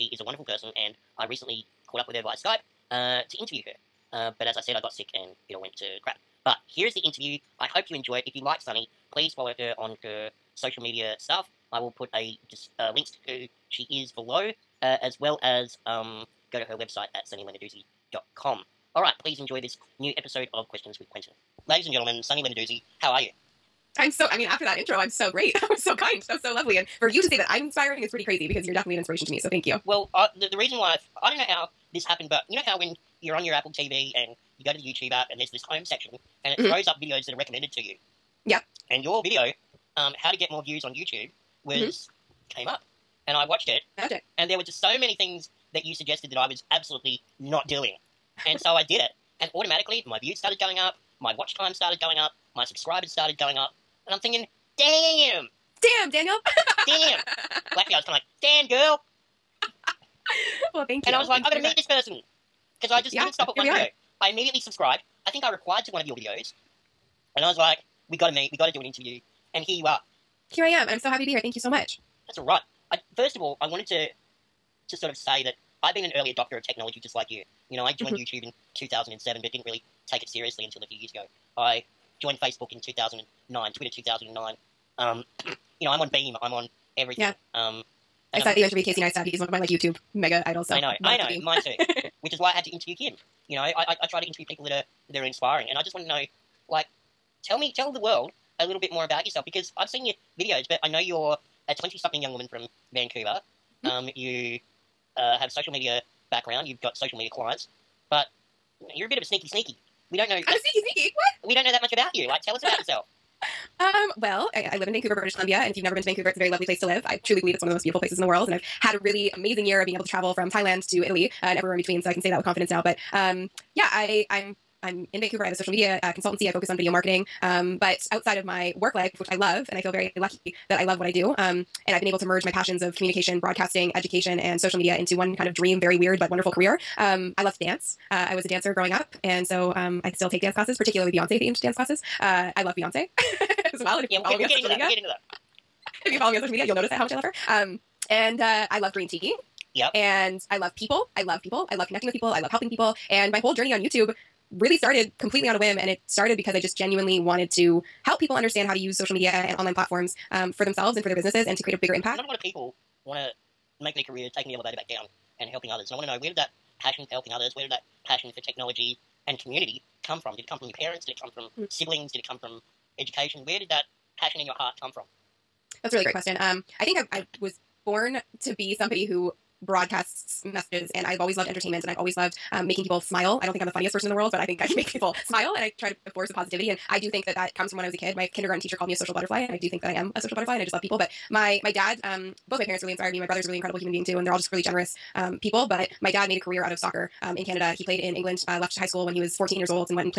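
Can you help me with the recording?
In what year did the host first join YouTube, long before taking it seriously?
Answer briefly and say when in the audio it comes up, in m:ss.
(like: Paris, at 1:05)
2007, at 1:18.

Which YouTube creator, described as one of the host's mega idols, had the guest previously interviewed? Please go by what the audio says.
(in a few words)
Casey Neistat.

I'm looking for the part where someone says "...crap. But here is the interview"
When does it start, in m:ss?
0:06.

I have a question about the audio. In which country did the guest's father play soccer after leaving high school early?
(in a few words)
England.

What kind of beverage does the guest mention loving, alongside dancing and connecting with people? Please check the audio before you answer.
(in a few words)
Green tea.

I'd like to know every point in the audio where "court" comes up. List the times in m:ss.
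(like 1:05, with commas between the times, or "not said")
not said.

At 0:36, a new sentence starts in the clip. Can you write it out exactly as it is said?
throws up videos that are recommended to you.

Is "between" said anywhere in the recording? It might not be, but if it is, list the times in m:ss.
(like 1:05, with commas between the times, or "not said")
2:01.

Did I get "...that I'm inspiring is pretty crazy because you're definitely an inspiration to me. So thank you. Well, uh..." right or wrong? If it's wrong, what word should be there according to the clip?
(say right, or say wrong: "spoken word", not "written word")
right.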